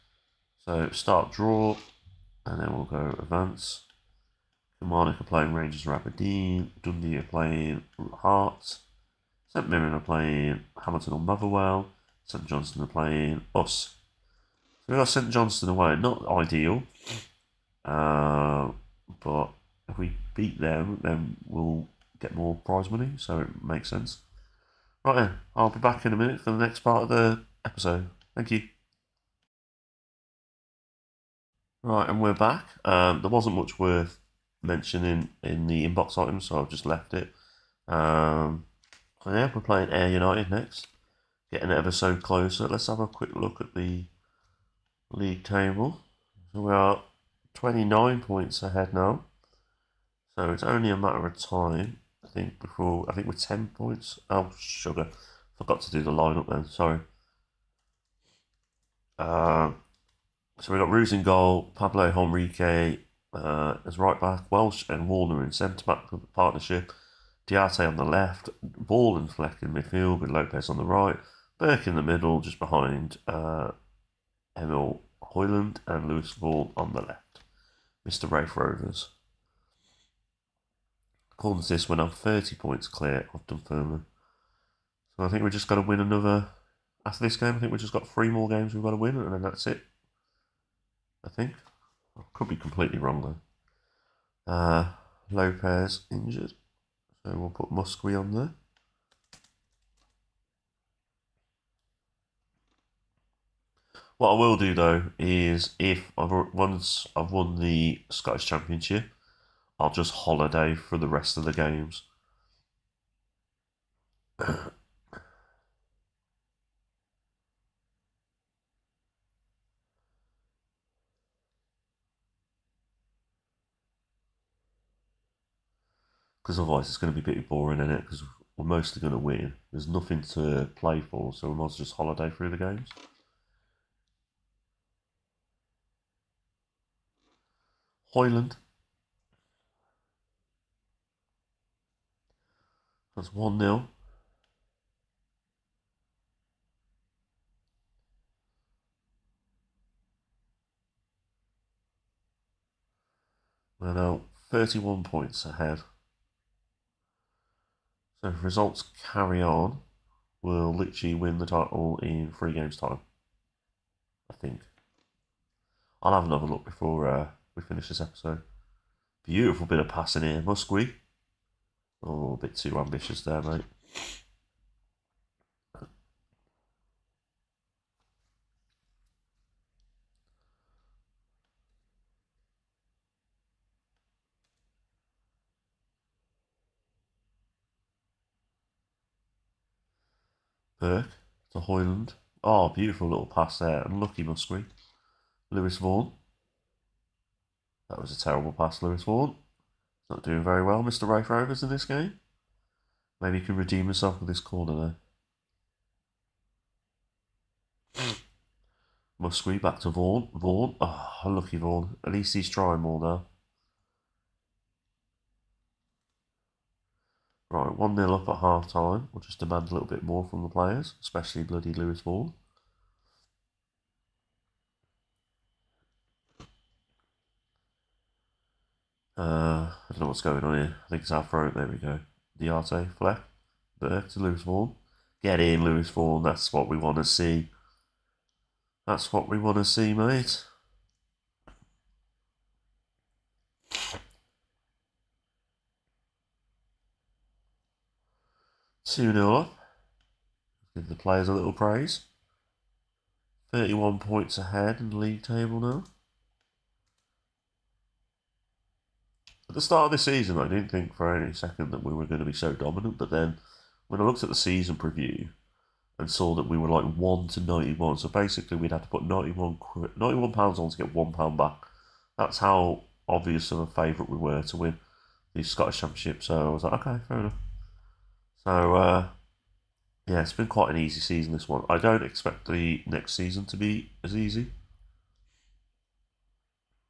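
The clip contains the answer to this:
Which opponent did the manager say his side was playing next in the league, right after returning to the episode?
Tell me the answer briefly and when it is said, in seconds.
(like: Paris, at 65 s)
Ayr United, at 39 s.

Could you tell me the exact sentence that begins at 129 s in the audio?
There's nothing to play for, so we might as well just holiday through the games.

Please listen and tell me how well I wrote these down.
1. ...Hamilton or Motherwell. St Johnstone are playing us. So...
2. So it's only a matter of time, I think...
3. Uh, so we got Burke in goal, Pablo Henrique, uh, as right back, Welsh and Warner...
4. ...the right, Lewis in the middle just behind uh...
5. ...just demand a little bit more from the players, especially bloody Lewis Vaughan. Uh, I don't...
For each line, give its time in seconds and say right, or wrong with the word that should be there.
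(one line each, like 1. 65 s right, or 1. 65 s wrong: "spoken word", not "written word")
1. 10 s right
2. 50 s right
3. 59 s wrong: "Ruse", not "Burke"
4. 70 s wrong: "Burke", not "Lewis"
5. 219 s right.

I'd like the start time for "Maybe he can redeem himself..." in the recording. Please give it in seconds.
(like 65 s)
203 s.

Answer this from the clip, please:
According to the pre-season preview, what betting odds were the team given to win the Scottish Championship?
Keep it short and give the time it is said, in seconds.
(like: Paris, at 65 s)
1 to 91, at 266 s.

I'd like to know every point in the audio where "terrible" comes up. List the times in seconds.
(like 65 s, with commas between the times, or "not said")
198 s.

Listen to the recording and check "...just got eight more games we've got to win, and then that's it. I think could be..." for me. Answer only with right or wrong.
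wrong.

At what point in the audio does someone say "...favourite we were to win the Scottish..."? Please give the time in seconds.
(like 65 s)
273 s.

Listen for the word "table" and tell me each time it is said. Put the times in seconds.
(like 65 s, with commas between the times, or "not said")
45 s, 255 s.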